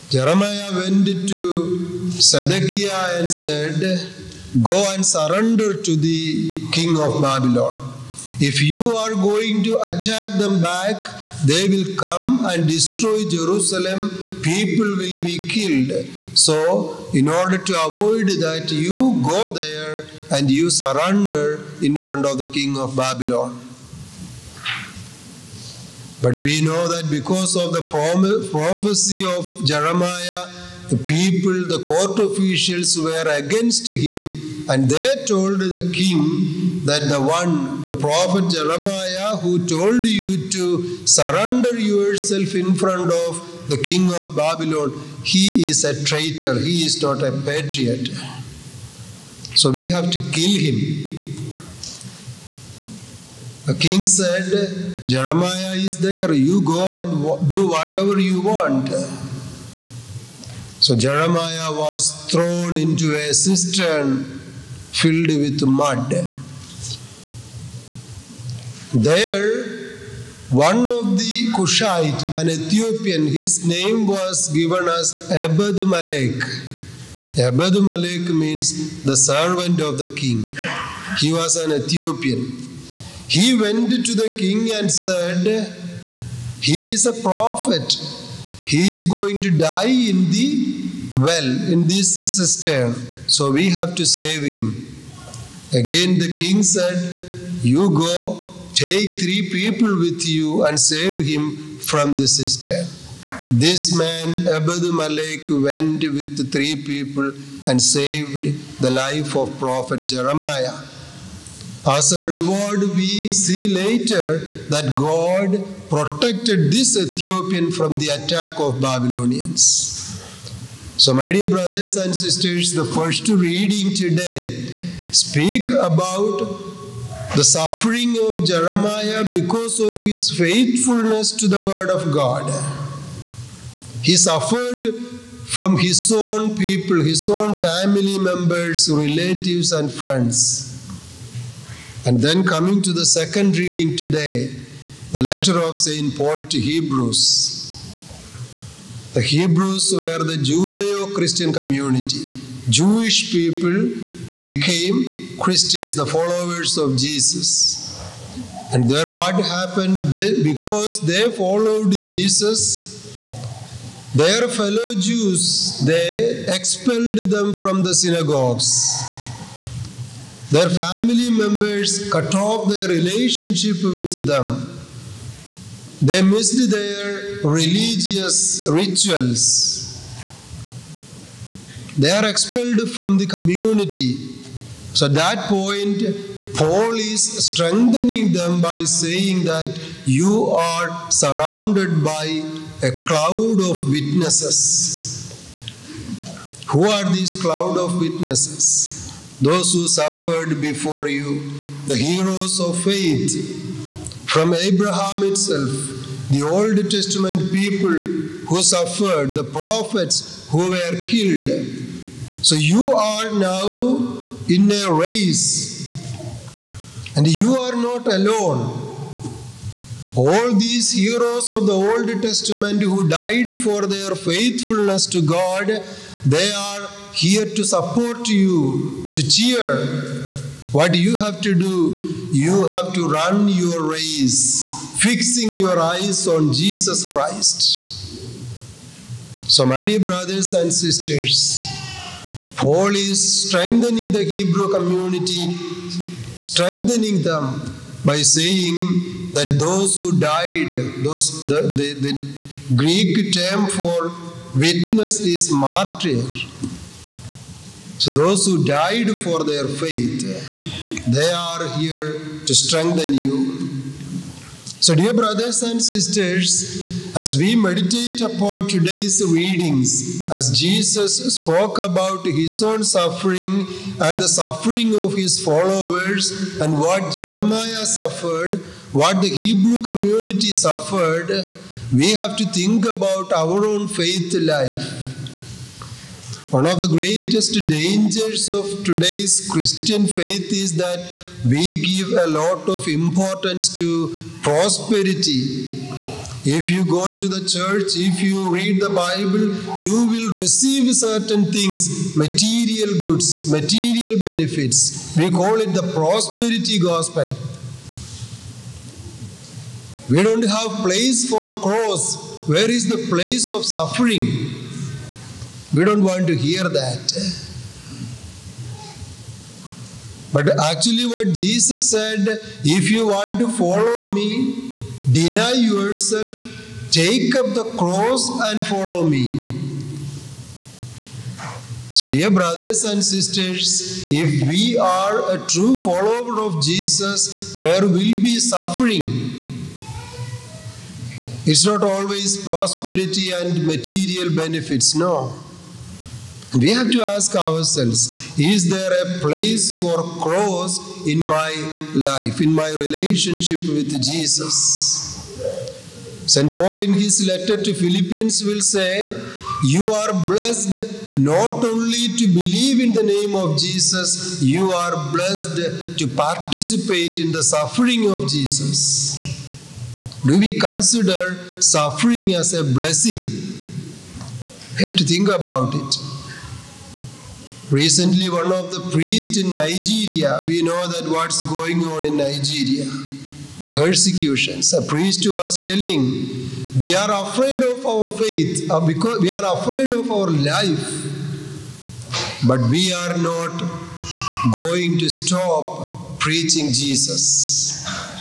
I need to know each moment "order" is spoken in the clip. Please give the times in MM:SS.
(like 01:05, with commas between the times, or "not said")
00:17.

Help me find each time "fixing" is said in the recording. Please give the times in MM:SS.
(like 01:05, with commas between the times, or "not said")
03:55.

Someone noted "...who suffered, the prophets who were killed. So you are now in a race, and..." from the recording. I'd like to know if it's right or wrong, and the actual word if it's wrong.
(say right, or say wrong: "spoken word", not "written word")
right.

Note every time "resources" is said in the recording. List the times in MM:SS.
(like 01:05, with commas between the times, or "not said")
not said.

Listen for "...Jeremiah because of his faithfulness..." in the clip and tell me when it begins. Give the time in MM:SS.
02:08.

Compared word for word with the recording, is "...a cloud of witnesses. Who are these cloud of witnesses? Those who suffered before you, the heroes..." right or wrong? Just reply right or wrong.
right.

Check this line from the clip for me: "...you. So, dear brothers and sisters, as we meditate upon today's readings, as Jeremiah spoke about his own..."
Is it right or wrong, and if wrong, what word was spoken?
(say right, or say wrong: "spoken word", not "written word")
wrong: "Jesus", not "Jeremiah".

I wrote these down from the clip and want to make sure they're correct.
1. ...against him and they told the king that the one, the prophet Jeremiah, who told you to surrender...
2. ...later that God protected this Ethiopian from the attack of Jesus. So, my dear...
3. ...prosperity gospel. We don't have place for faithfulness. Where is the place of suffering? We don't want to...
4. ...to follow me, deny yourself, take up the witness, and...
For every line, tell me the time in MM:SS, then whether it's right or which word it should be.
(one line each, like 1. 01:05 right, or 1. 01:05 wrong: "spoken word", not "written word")
1. 00:33 right
2. 01:53 wrong: "Babylonians", not "Jesus"
3. 05:05 wrong: "cross", not "faithfulness"
4. 05:23 wrong: "cross", not "witness".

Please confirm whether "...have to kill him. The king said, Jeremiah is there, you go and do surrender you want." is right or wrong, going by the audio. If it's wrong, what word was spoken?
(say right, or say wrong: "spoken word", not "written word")
wrong: "whatever", not "surrender".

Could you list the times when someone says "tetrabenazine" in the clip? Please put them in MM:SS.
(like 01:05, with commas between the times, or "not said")
not said.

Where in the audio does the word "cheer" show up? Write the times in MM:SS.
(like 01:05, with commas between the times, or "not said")
03:49.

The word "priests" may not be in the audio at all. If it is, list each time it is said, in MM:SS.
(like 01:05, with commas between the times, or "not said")
06:18, 06:24.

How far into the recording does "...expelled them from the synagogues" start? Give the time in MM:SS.
02:46.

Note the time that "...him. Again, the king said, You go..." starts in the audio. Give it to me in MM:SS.
01:34.